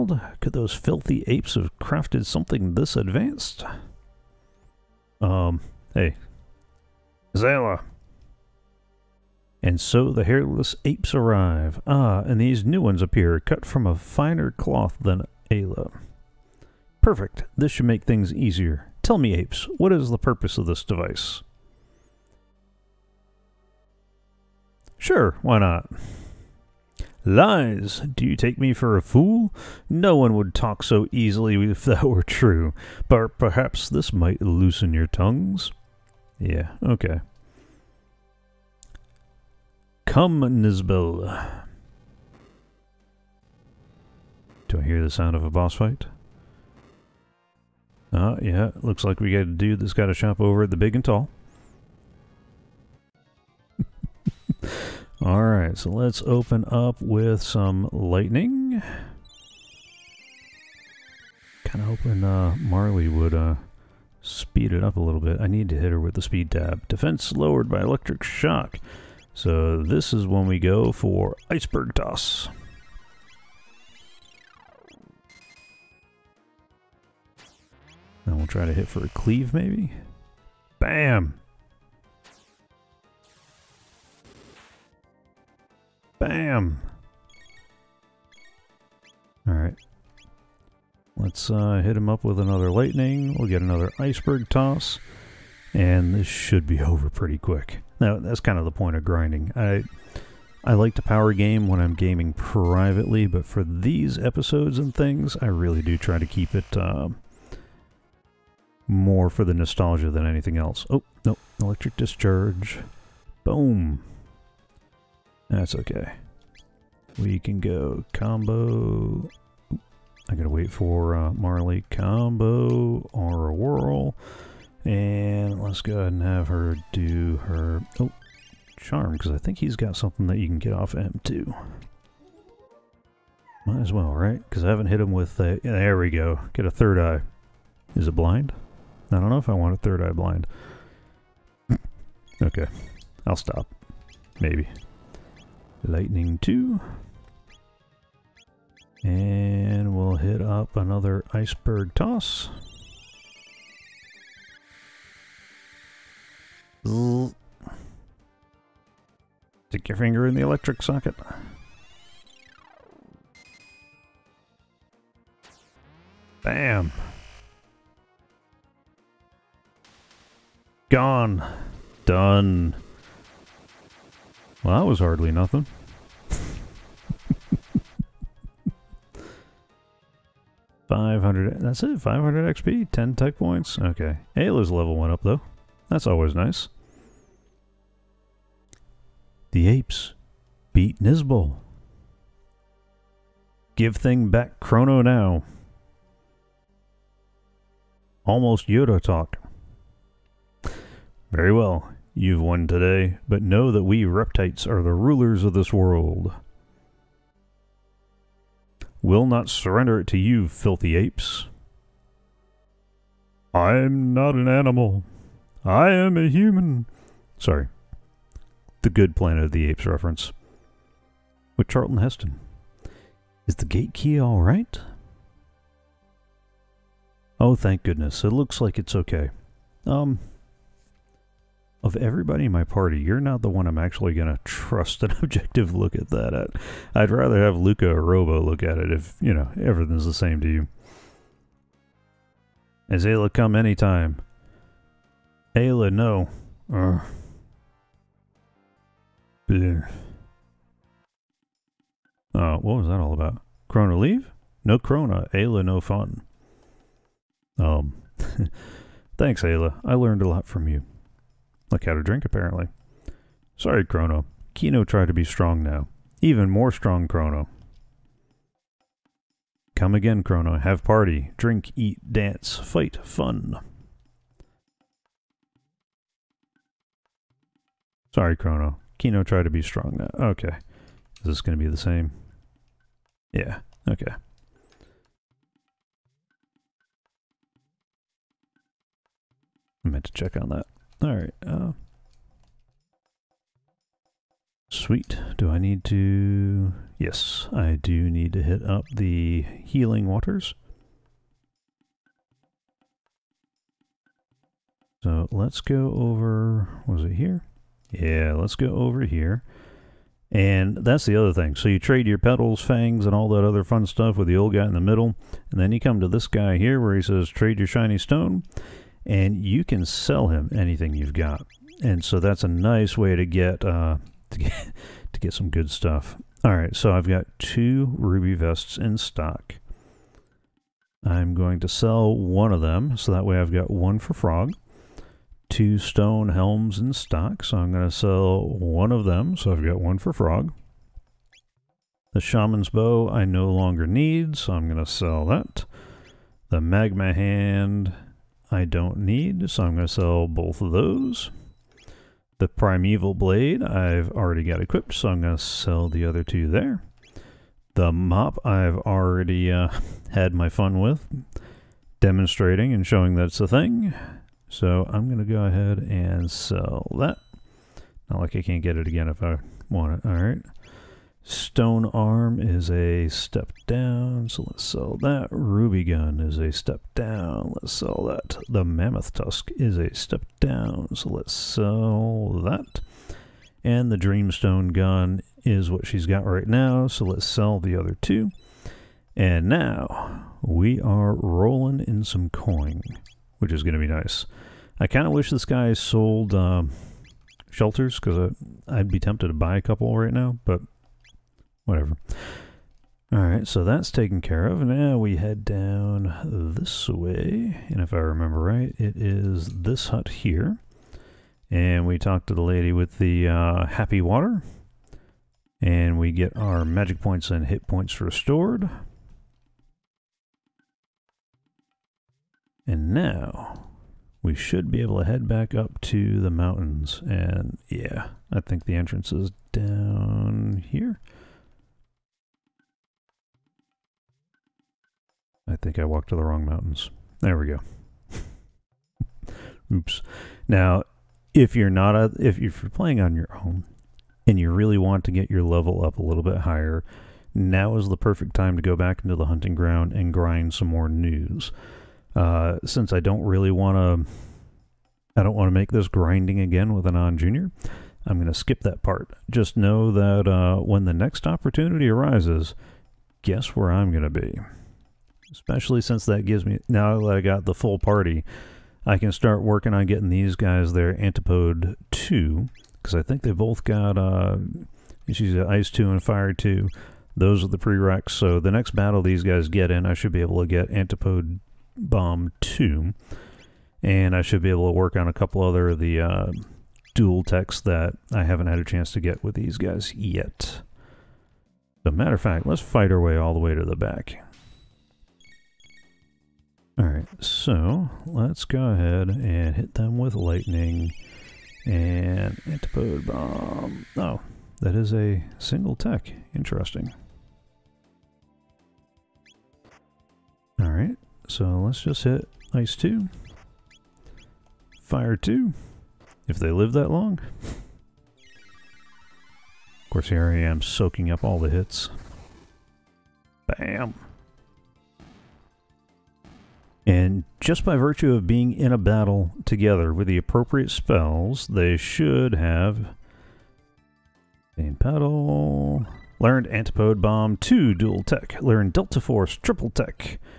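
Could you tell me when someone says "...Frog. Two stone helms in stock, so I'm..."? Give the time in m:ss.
5:34.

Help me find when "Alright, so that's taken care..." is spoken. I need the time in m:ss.
6:43.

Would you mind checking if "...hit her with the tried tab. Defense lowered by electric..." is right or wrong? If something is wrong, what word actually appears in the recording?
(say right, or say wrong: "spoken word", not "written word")
wrong: "speed", not "tried".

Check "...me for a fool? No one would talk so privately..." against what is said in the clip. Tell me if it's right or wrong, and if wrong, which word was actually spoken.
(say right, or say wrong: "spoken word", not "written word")
wrong: "easily", not "privately".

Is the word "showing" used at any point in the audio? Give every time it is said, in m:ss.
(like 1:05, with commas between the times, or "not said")
6:02.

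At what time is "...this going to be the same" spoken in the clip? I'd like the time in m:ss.
4:41.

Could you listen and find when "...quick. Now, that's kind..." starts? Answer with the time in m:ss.
1:37.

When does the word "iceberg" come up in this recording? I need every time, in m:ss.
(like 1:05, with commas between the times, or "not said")
1:11, 1:33, 2:31.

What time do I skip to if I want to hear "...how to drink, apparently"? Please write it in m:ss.
4:21.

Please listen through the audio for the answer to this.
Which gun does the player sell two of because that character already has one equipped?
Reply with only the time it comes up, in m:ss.
6:23.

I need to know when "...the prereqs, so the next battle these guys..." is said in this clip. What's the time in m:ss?
7:57.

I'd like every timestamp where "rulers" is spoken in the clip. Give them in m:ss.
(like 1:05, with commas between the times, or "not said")
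3:24.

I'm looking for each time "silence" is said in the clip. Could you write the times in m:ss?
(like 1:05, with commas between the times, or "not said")
not said.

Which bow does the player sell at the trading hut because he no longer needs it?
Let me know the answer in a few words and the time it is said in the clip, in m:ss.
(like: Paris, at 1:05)
Shaman's Bow, at 5:42.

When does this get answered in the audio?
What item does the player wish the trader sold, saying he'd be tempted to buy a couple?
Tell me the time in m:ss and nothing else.
6:37.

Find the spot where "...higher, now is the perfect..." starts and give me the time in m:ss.
7:26.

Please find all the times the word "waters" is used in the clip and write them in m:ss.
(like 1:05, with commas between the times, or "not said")
5:00, 6:54.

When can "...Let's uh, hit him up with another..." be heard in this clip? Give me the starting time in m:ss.
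1:31.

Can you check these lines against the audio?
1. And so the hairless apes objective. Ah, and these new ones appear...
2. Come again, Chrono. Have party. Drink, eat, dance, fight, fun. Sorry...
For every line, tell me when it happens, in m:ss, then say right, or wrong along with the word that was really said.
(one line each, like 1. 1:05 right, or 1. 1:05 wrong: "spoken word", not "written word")
1. 0:09 wrong: "arrive", not "objective"
2. 4:29 right.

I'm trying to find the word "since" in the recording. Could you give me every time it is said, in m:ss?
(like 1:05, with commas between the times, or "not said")
7:32, 7:45.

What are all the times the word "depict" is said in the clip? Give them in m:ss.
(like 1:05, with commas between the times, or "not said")
not said.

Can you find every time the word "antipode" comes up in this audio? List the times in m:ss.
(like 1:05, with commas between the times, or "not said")
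7:50, 8:00, 8:22, 8:56.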